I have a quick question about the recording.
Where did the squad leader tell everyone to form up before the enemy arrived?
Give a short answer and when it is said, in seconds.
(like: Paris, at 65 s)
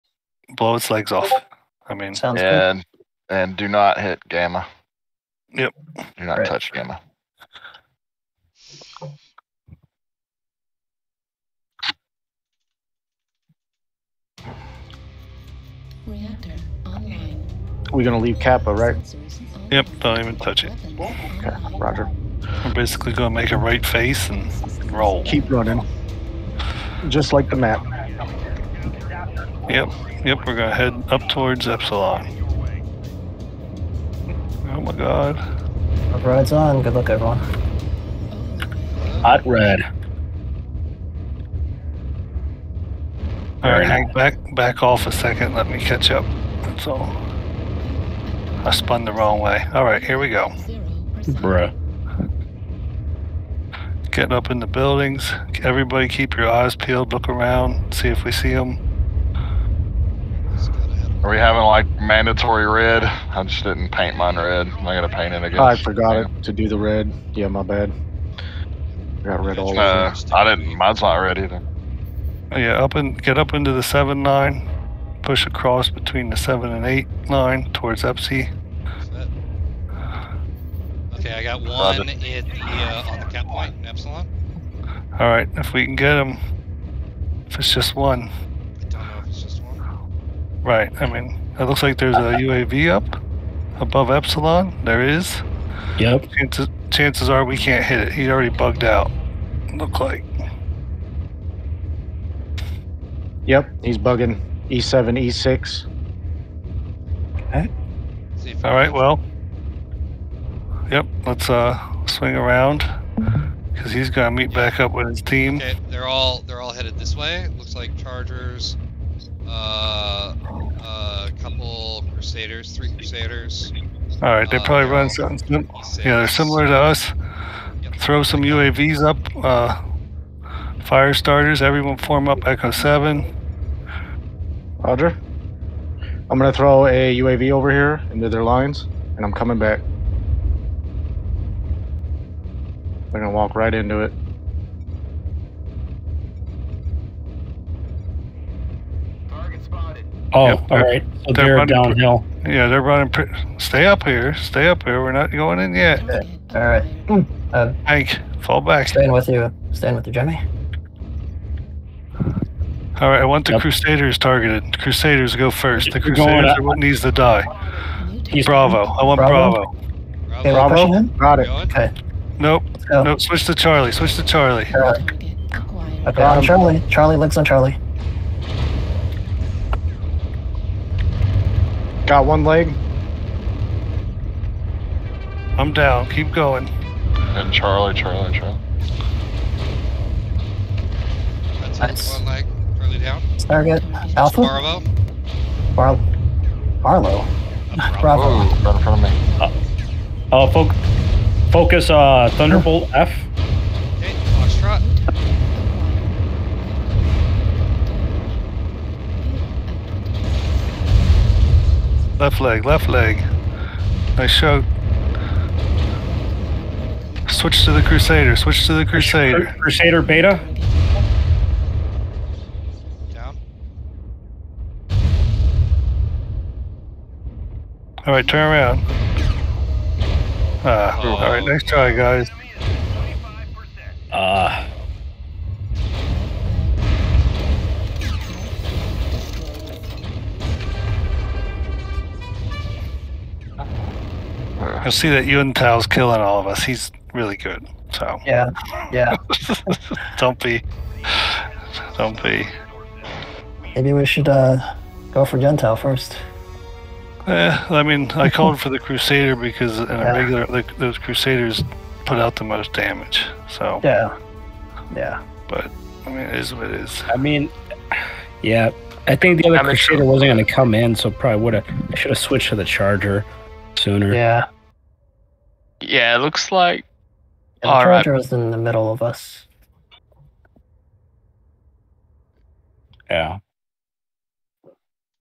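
Echo Seven, at 132 s.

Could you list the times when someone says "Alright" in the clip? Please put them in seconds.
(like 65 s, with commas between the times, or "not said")
43 s, 49 s.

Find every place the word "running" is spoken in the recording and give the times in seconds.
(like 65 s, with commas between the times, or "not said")
25 s, 152 s.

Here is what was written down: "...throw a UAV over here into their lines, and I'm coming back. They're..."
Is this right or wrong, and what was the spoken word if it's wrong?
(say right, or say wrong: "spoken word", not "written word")
right.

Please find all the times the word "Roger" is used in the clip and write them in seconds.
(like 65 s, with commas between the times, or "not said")
21 s, 134 s.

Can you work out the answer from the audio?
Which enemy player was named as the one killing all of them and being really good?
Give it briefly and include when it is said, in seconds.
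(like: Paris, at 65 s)
Tao, at 245 s.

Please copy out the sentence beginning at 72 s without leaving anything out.
Yeah, up and get up into the seven nine, push across between the seven and eight nine towards Epsi.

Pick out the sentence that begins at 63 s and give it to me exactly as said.
I just didn't paint mine red.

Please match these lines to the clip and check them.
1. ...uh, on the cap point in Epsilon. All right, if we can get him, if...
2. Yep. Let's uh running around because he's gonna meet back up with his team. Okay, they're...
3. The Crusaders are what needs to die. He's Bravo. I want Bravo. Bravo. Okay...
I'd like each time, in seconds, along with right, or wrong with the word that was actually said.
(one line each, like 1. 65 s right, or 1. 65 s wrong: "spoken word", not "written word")
1. 82 s right
2. 110 s wrong: "swing", not "running"
3. 165 s right.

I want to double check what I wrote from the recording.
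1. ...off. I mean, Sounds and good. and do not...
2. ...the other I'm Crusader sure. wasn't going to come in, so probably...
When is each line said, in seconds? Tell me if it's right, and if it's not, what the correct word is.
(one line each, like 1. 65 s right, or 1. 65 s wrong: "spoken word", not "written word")
1. 1 s right
2. 269 s right.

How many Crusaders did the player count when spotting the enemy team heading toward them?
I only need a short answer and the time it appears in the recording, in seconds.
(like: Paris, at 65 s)
3, at 122 s.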